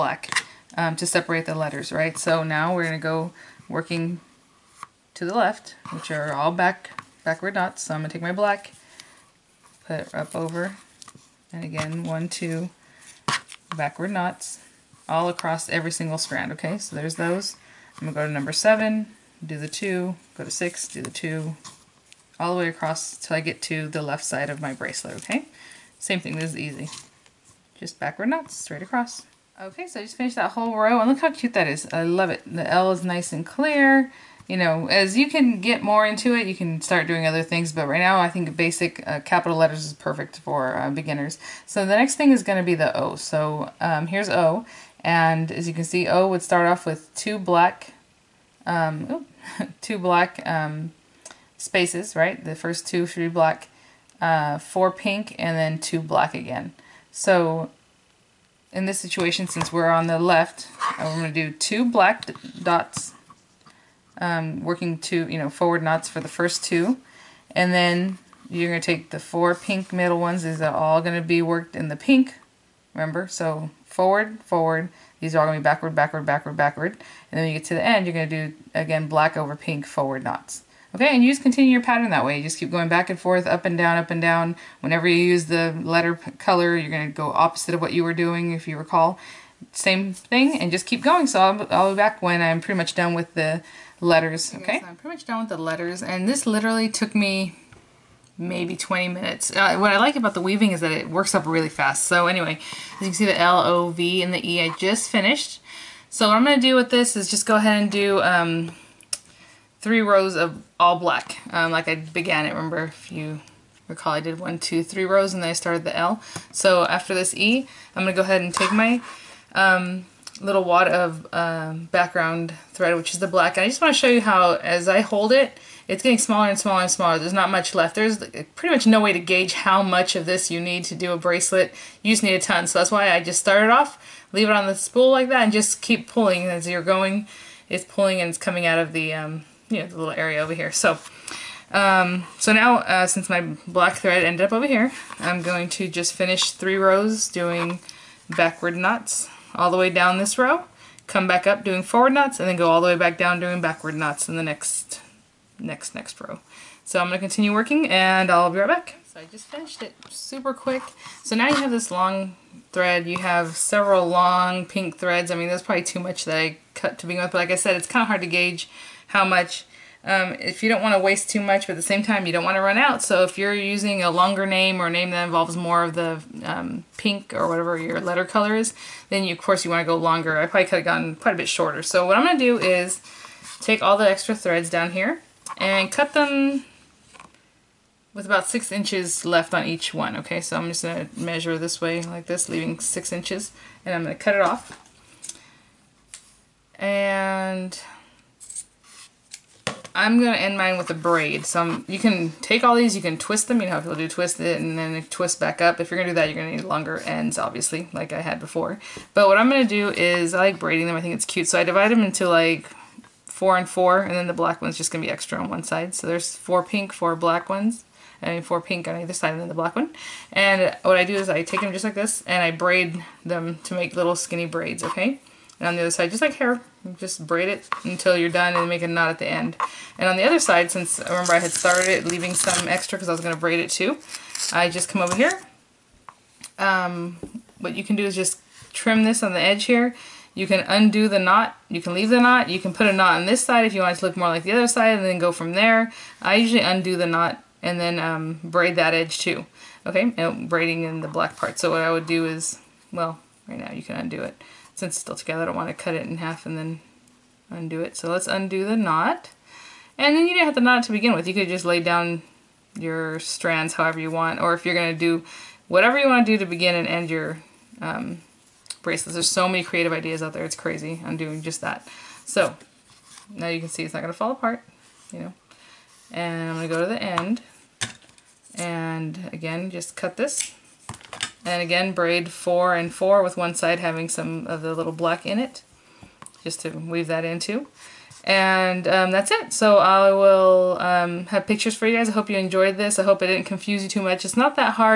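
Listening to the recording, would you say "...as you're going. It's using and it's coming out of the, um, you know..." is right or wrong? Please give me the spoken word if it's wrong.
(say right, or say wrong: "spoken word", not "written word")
wrong: "pulling", not "using".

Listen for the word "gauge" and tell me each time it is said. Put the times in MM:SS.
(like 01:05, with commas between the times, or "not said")
02:09, 02:48.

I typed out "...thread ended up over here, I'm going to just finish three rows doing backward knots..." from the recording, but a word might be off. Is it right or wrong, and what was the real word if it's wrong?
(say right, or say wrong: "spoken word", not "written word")
right.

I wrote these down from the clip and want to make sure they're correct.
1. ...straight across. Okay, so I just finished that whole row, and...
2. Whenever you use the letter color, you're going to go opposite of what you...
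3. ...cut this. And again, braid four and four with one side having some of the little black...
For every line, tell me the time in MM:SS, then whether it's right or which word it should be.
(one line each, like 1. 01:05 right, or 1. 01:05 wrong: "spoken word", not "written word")
1. 00:28 right
2. 01:24 right
3. 04:39 right.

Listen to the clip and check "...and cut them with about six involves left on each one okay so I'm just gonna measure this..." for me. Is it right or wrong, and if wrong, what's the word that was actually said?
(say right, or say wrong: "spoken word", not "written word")
wrong: "inches", not "involves".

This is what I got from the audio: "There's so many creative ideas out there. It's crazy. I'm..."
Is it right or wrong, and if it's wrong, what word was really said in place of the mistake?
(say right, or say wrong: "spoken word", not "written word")
right.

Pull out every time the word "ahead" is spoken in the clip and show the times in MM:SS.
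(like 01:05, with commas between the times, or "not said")
01:47, 01:58.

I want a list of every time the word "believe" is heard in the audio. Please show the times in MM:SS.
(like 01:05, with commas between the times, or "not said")
not said.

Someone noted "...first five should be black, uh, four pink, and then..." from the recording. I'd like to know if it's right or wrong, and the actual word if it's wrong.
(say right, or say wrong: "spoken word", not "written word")
wrong: "two", not "five".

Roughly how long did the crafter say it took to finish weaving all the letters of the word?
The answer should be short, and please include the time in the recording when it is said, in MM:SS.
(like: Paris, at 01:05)
20 minutes, at 01:38.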